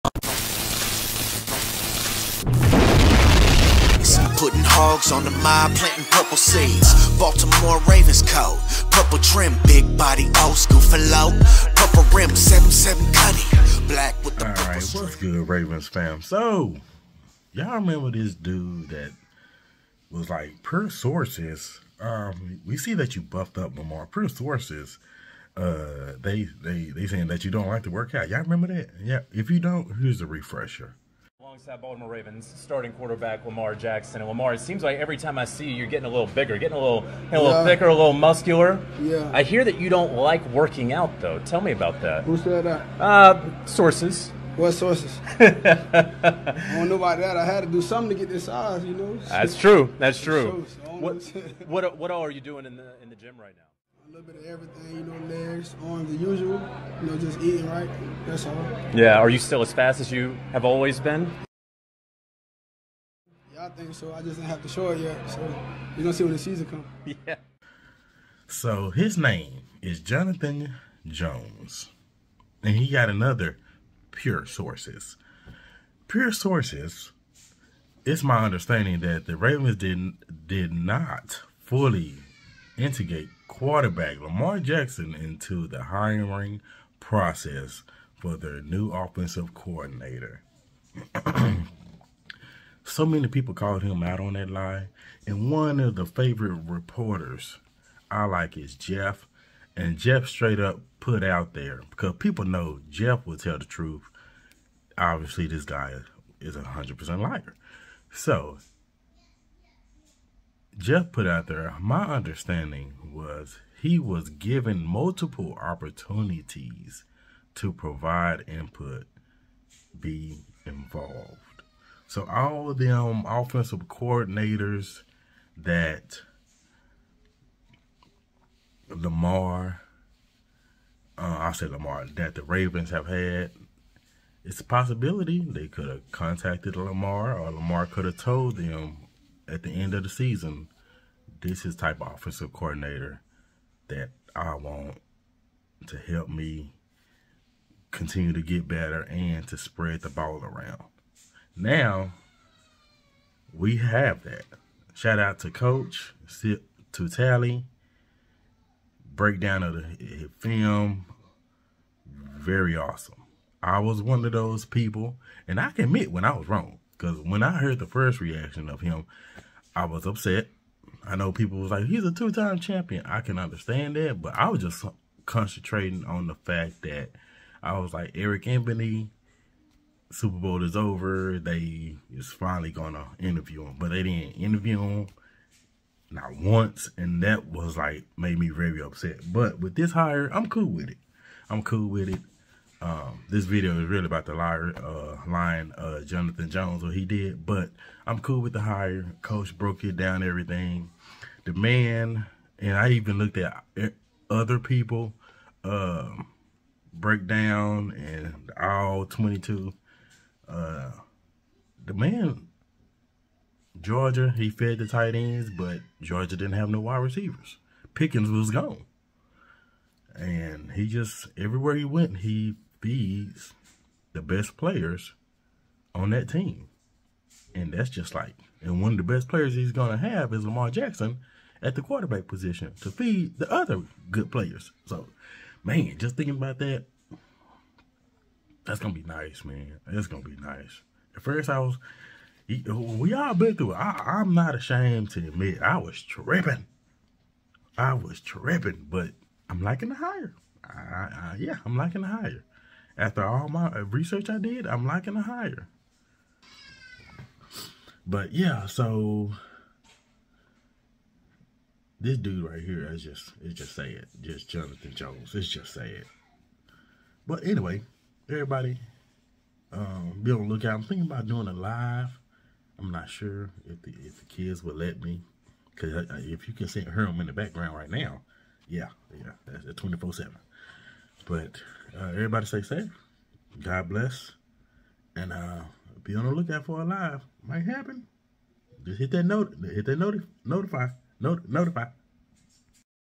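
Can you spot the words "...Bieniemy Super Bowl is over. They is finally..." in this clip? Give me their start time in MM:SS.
02:58.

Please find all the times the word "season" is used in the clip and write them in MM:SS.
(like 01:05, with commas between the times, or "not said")
01:06, 02:20.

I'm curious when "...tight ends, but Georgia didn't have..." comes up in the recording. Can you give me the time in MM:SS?
03:34.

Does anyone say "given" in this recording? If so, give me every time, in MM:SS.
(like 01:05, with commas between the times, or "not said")
01:54.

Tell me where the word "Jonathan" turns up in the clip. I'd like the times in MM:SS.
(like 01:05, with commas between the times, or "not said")
01:10, 03:16, 04:24.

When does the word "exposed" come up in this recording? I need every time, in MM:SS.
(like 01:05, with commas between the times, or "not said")
not said.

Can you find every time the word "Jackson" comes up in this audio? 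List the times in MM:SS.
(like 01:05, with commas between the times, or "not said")
00:33, 01:24, 03:50.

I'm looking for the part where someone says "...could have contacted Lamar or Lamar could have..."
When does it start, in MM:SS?
02:15.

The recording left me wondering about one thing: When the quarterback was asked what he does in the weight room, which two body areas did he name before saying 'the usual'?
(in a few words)
legs, arms.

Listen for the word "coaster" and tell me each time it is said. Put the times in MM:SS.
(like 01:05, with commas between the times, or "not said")
not said.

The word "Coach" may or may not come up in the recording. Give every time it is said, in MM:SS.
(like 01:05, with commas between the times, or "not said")
02:35, 03:19.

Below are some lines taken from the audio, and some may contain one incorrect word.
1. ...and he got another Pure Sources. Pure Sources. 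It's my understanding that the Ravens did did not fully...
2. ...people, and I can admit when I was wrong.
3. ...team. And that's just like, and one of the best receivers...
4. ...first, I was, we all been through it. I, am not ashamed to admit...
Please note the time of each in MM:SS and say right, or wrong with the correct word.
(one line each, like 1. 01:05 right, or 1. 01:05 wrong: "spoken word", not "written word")
1. 01:12 right
2. 02:44 right
3. 03:46 wrong: "players", not "receivers"
4. 04:01 right.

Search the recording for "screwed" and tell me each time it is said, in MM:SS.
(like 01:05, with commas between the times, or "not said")
not said.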